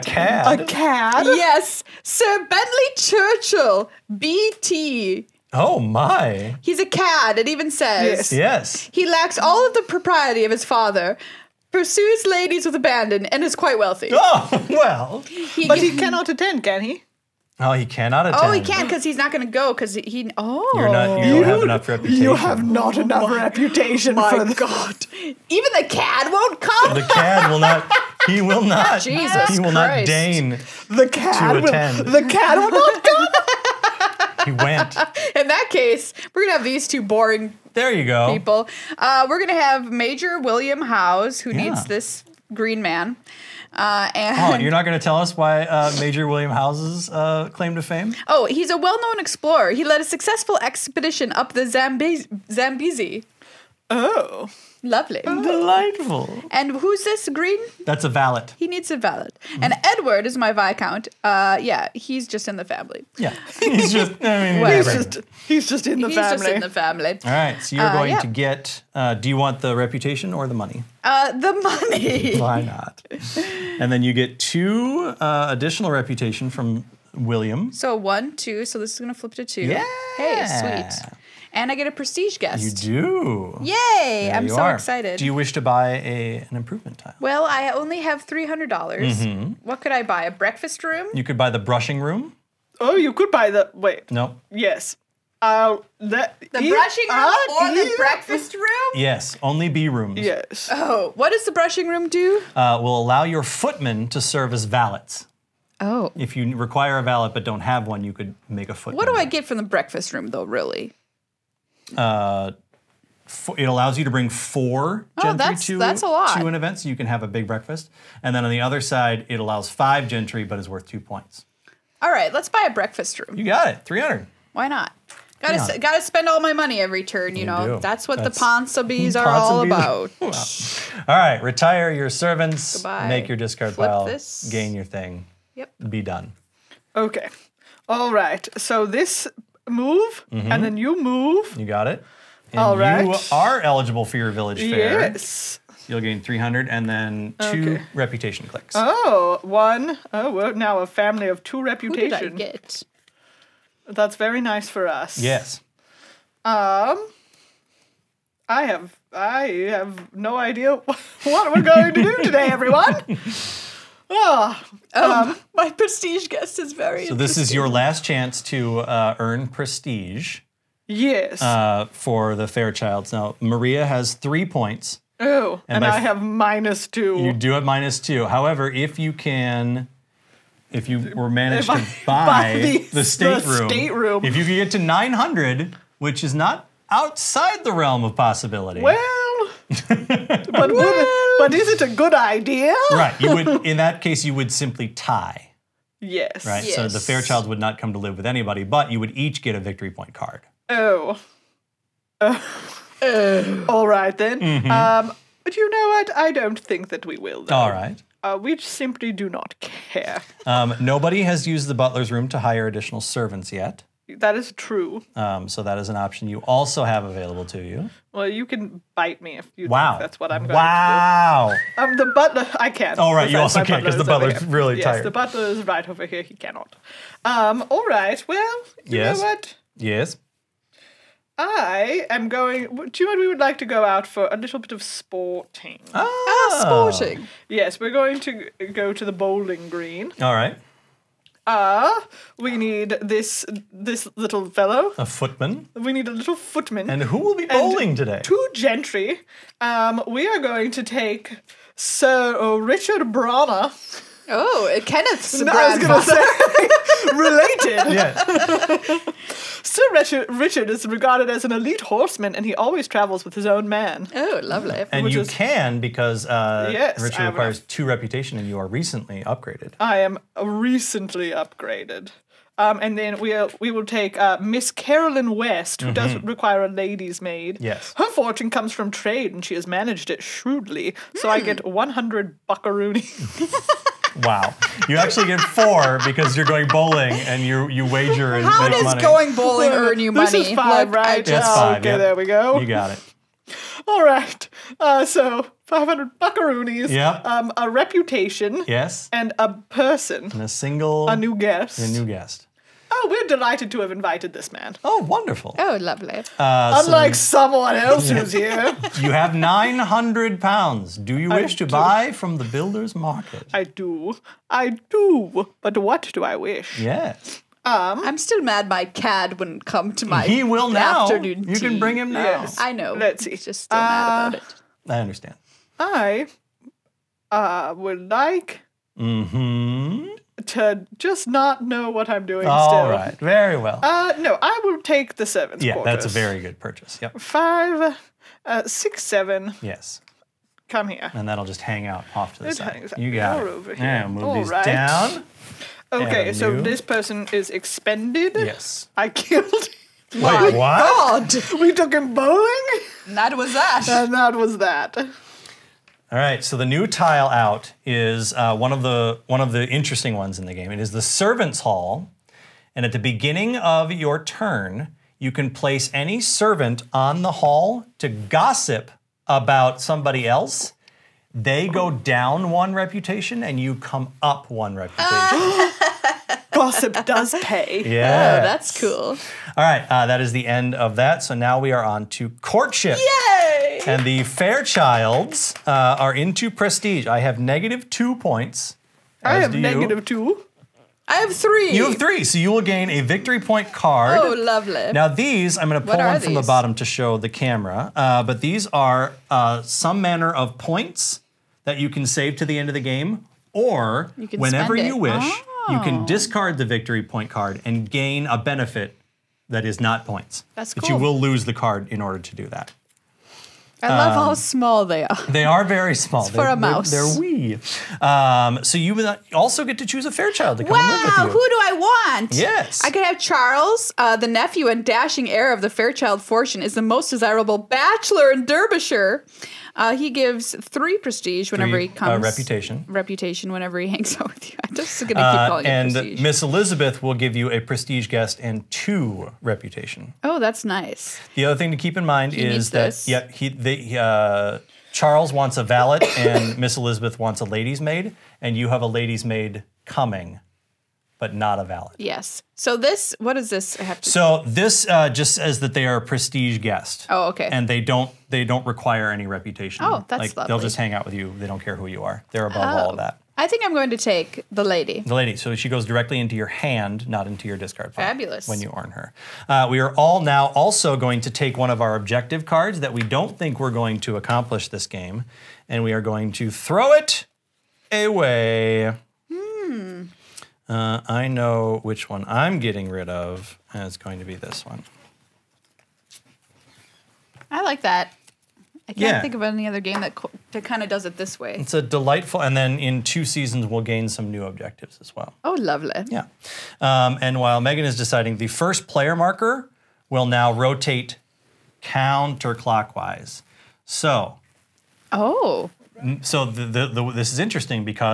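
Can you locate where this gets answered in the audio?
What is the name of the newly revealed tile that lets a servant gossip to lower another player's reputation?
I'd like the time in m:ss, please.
6:01.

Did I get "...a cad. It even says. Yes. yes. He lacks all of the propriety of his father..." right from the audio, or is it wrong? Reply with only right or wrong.
right.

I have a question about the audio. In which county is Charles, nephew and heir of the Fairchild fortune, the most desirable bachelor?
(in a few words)
Derbyshire.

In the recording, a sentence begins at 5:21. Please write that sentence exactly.
Afternoon you can bring him now.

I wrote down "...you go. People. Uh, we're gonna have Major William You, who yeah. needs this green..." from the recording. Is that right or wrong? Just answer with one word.
wrong.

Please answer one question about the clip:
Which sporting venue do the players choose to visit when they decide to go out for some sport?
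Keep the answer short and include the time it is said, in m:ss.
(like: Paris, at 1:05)
The bowling green, at 3:59.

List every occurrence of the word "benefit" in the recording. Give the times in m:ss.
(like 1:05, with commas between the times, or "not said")
6:48.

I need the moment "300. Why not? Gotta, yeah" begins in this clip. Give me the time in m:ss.
2:03.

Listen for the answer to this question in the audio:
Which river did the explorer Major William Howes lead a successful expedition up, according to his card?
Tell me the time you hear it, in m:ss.
0:51.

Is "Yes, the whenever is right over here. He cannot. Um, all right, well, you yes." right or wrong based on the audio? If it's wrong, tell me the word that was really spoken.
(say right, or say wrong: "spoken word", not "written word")
wrong: "butler", not "whenever".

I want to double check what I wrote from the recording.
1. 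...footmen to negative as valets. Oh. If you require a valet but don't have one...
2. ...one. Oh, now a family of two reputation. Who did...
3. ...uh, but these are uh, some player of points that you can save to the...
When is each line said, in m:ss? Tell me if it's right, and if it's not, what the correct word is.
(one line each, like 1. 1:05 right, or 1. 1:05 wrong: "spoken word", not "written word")
1. 1:43 wrong: "serve", not "negative"
2. 2:29 right
3. 6:37 wrong: "manner", not "player".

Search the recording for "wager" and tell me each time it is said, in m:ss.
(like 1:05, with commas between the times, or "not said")
4:47.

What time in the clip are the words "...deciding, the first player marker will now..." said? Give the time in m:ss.
8:17.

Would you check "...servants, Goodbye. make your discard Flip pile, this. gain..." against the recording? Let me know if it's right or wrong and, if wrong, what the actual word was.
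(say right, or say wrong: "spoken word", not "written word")
right.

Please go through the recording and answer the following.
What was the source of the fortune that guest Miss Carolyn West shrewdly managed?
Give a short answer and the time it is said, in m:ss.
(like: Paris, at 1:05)
Trade, at 4:38.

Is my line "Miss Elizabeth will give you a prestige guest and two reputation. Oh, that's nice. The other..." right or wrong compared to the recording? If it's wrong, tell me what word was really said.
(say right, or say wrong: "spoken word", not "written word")
right.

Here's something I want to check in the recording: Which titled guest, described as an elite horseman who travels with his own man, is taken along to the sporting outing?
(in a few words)
Sir Richard Branagh.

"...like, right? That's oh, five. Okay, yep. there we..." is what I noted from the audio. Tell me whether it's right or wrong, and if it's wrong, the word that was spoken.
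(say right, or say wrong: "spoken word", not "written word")
right.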